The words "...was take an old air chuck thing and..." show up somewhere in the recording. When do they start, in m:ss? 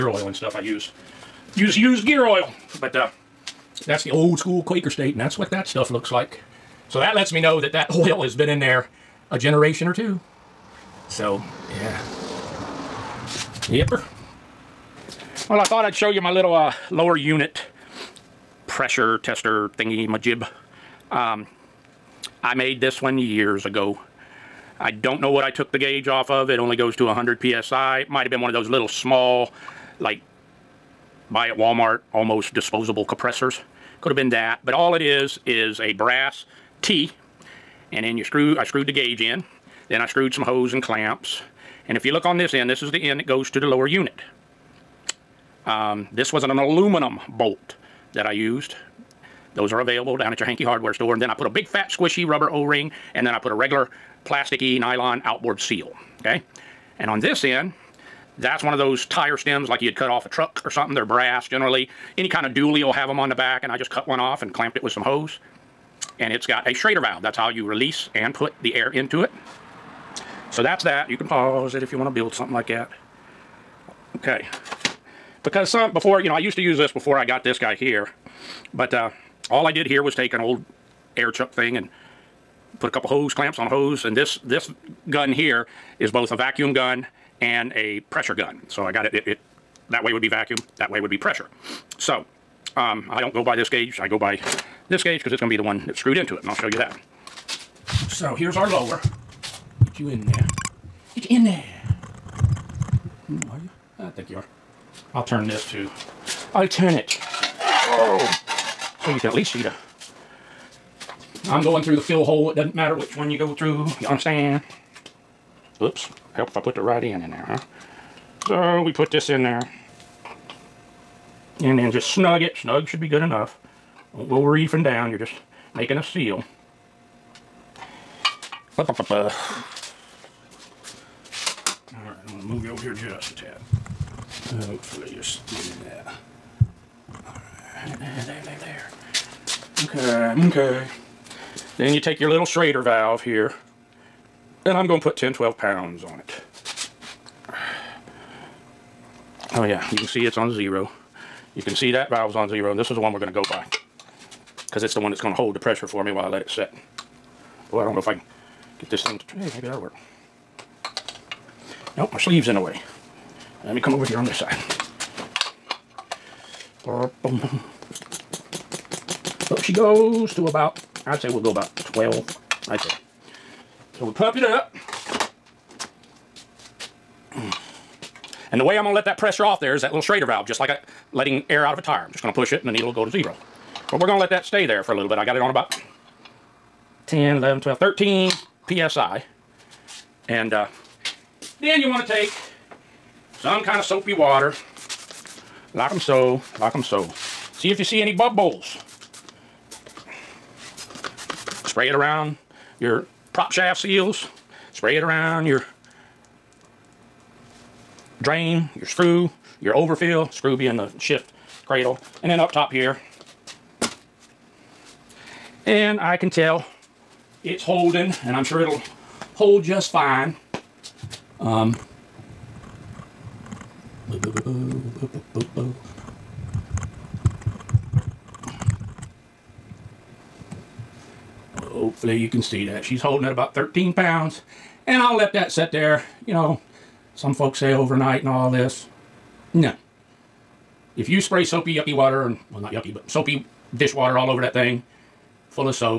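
1:20.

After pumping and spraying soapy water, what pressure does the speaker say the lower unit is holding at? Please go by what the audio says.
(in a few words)
13 pounds.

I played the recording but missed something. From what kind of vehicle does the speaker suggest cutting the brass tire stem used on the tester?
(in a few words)
dually.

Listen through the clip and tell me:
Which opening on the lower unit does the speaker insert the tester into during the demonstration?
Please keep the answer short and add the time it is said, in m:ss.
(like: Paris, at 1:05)
fill hole, at 1:52.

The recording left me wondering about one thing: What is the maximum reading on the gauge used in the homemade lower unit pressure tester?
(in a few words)
100 PSI.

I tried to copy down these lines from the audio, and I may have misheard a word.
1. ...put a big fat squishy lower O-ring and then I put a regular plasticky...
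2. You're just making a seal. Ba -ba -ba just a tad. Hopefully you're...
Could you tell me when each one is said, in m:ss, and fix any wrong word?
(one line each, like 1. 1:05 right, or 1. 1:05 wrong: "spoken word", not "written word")
1. 0:51 wrong: "rubber", not "lower"
2. 2:05 right.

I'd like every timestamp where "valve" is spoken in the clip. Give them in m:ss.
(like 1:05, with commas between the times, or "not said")
1:06, 2:22, 2:32, 3:00.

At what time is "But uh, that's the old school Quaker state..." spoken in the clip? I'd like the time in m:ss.
0:02.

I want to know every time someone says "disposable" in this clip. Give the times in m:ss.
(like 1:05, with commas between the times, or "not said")
0:32.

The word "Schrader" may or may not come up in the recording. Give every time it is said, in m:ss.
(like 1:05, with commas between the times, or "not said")
1:06, 2:22, 3:00.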